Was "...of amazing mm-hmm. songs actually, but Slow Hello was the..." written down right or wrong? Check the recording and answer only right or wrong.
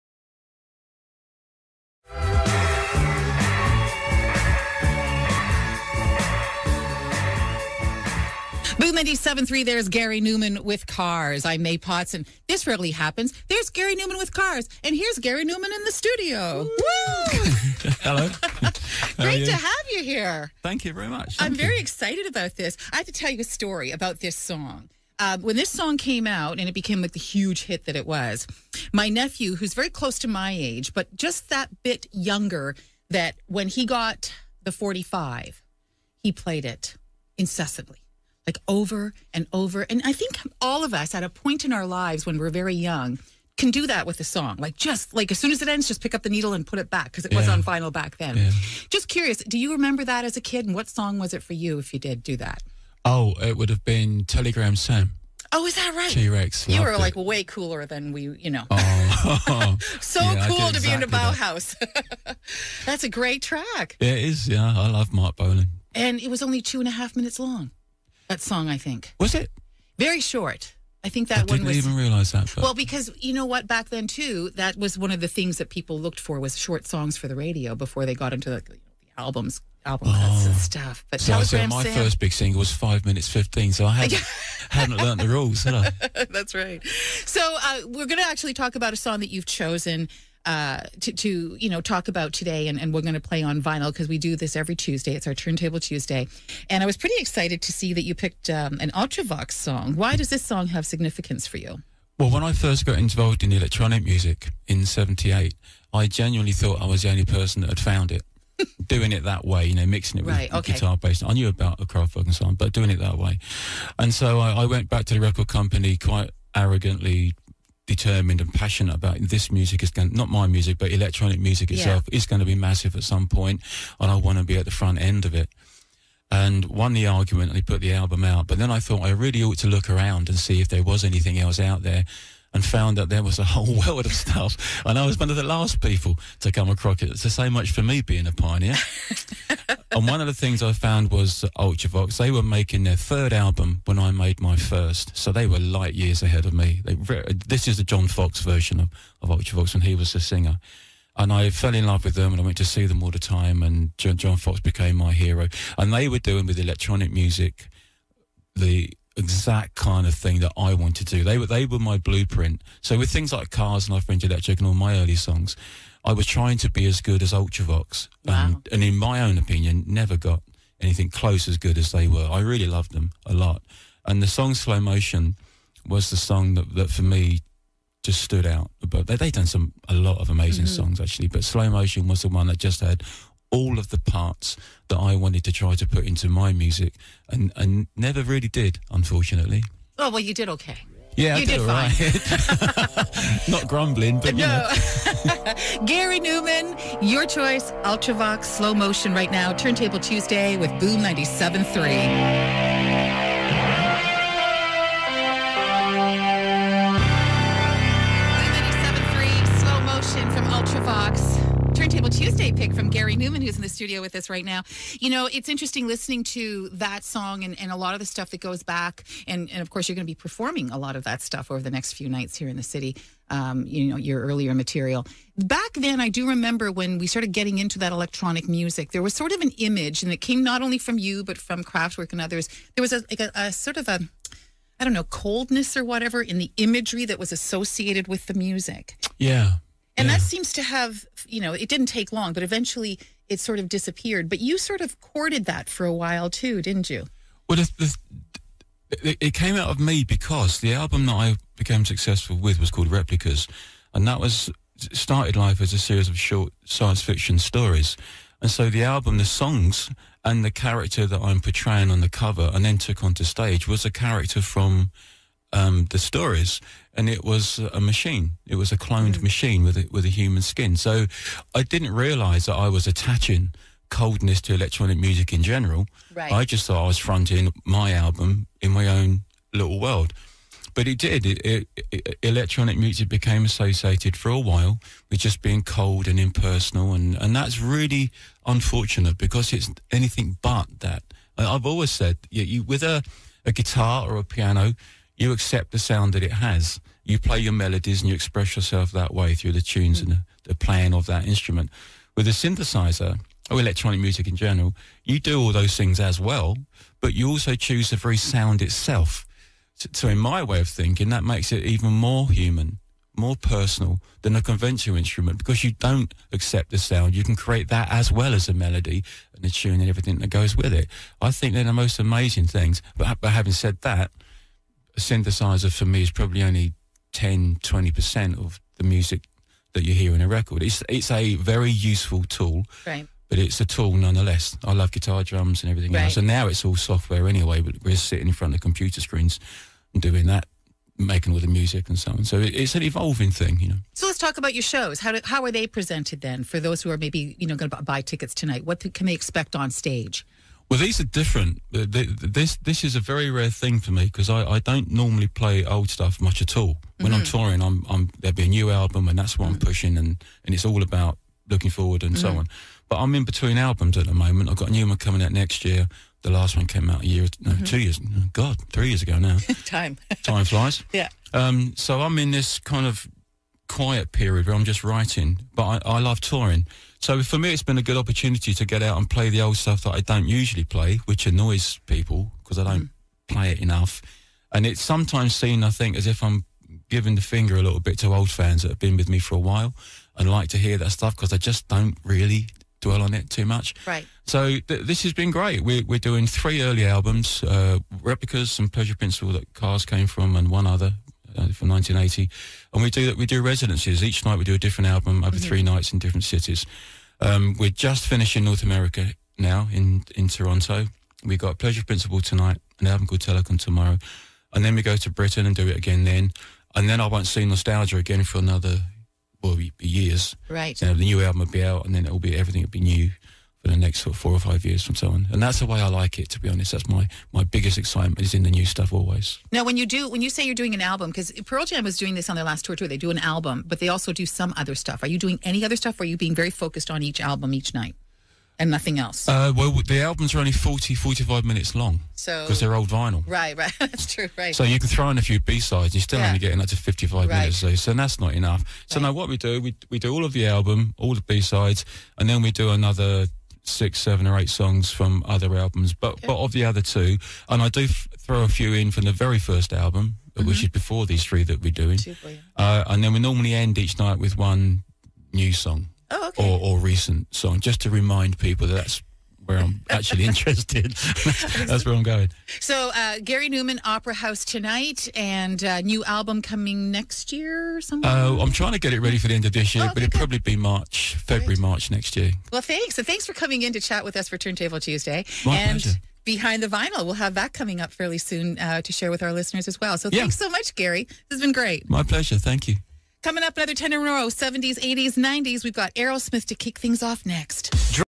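wrong.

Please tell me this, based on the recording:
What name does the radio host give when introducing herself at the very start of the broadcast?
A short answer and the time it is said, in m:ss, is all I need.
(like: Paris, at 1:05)
Maie Pauts, at 0:11.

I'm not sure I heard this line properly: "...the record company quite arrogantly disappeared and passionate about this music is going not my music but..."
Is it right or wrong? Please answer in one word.
wrong.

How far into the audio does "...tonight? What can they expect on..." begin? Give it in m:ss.
5:48.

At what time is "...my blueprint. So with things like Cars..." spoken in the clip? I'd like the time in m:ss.
2:41.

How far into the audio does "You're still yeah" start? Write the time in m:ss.
7:25.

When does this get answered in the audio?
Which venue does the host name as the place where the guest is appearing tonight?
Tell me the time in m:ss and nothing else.
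7:53.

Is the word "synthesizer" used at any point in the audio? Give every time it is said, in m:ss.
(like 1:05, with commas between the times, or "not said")
5:02, 5:24.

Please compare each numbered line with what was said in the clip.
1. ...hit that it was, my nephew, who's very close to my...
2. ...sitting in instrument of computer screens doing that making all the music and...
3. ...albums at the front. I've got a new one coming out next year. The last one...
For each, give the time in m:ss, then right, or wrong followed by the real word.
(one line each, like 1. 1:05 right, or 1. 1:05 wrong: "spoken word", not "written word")
1. 0:27 right
2. 5:37 wrong: "front", not "instrument"
3. 6:03 wrong: "moment", not "front".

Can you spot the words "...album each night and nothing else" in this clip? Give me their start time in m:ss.
7:17.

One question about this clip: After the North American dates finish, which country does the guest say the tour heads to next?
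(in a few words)
Britain.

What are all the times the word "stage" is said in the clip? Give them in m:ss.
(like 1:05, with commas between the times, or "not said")
4:23, 5:49.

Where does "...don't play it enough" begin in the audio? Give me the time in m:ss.
6:22.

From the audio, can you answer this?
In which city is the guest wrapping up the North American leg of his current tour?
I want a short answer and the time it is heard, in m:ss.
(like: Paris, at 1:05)
Toronto, at 6:50.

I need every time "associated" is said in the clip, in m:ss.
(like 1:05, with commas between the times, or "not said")
3:57, 4:43.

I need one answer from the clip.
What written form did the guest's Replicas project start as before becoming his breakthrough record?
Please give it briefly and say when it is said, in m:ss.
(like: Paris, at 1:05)
Short science fiction stories, at 4:16.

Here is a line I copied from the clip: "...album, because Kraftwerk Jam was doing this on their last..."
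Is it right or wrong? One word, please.
wrong.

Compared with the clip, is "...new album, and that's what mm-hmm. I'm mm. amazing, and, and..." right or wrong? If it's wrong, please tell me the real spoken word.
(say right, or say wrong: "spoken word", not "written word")
wrong: "pushing", not "amazing".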